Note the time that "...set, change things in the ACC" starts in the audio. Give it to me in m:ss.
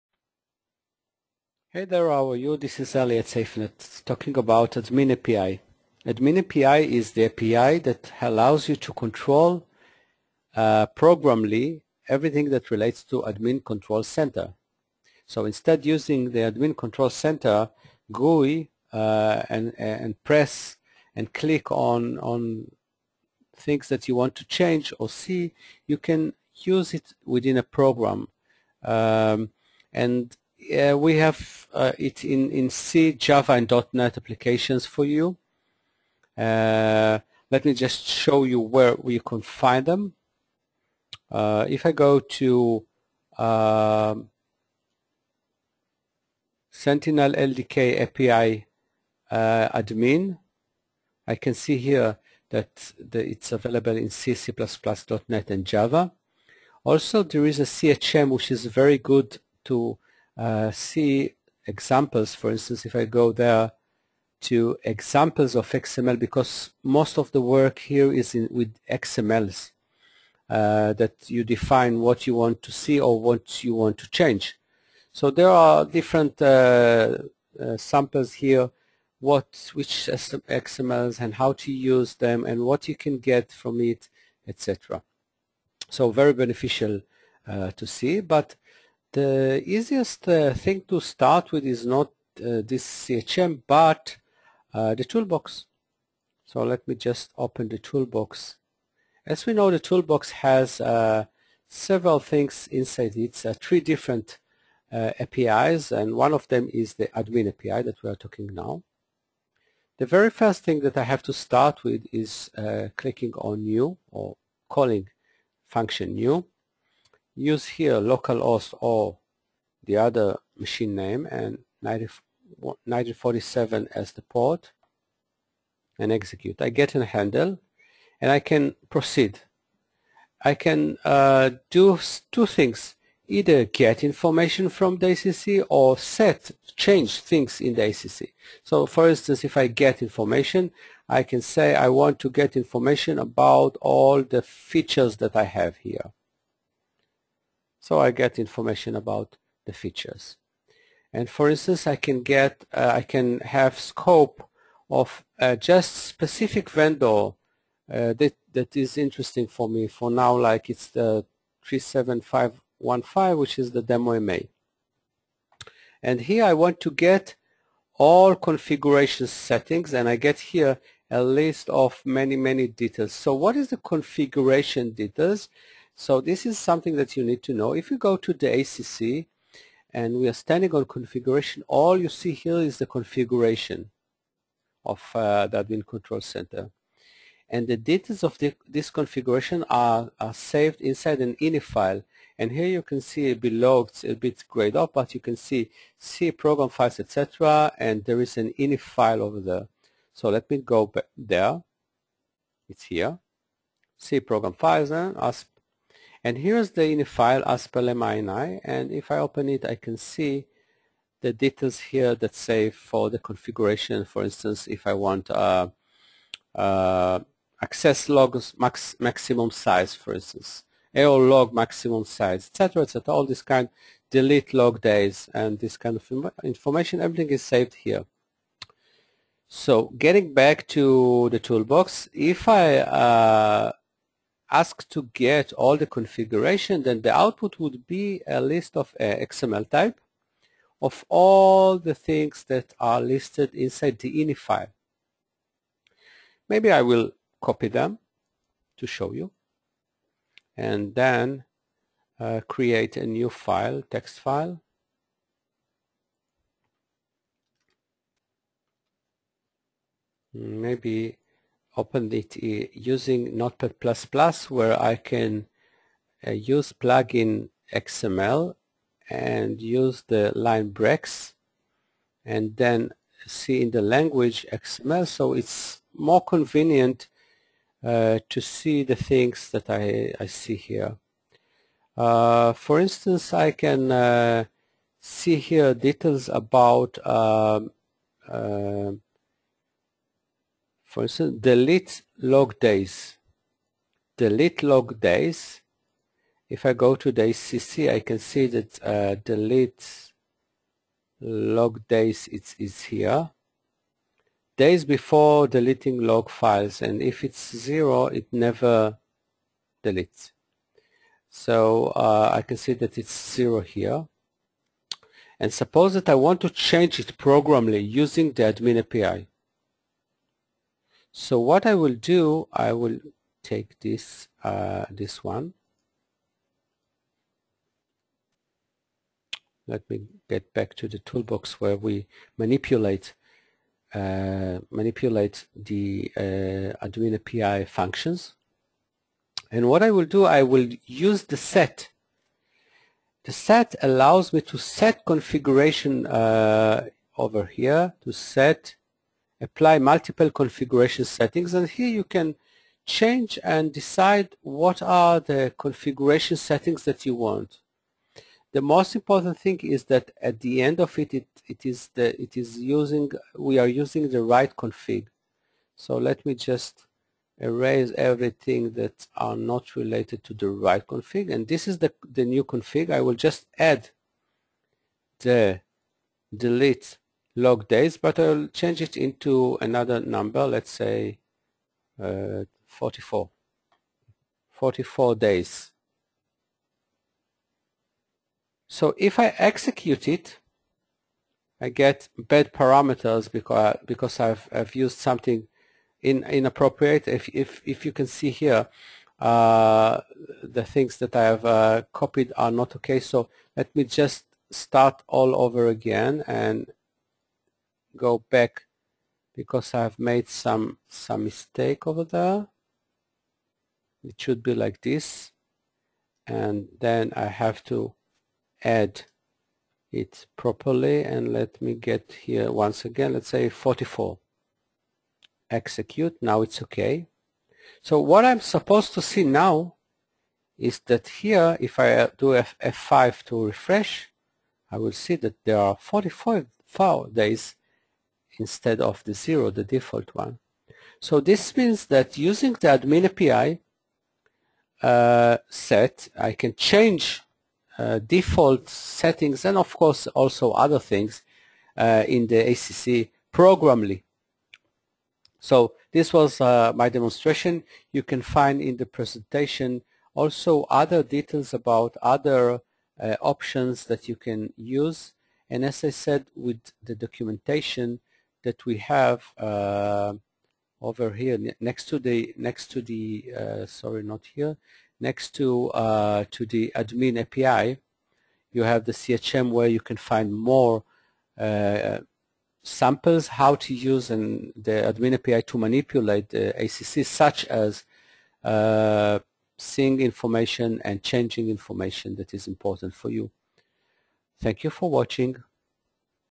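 2:15.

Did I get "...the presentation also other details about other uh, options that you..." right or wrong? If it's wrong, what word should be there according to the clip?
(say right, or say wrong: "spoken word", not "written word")
right.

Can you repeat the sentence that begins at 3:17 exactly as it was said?
And there is an ini file over there.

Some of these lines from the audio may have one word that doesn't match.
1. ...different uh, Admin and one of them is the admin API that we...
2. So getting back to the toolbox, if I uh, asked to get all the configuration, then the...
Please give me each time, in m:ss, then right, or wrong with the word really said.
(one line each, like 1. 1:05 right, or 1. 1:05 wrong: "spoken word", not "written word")
1. 1:43 wrong: "APIs", not "Admin"
2. 3:49 right.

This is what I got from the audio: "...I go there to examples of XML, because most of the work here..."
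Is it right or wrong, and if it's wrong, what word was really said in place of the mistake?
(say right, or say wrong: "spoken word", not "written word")
right.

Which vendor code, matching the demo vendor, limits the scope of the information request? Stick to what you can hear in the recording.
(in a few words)
37515.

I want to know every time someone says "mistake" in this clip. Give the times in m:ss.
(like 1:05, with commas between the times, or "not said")
6:51.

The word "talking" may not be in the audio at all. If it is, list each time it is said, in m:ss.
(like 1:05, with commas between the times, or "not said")
0:04, 1:48.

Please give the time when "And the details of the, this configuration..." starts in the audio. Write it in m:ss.
3:07.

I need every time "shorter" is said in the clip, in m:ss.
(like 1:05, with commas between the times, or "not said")
not said.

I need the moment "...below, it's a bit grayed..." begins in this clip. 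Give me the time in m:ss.
3:13.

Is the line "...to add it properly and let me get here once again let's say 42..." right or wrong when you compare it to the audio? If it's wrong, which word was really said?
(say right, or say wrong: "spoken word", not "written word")
wrong: "44", not "42".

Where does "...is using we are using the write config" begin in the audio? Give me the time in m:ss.
6:02.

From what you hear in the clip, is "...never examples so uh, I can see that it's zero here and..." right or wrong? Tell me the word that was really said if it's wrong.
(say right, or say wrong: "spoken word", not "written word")
wrong: "deletes", not "examples".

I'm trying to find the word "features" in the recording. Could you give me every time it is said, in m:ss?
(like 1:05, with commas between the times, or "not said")
2:24, 2:29.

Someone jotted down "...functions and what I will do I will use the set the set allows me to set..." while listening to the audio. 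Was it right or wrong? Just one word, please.
right.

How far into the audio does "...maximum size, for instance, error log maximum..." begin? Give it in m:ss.
3:38.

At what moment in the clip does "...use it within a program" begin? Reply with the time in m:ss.
0:26.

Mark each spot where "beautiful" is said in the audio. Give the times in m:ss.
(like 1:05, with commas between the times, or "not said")
not said.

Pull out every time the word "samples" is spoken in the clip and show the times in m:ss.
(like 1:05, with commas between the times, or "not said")
1:17, 8:02.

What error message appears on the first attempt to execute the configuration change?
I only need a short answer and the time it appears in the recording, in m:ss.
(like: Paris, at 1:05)
bad parameters, at 6:32.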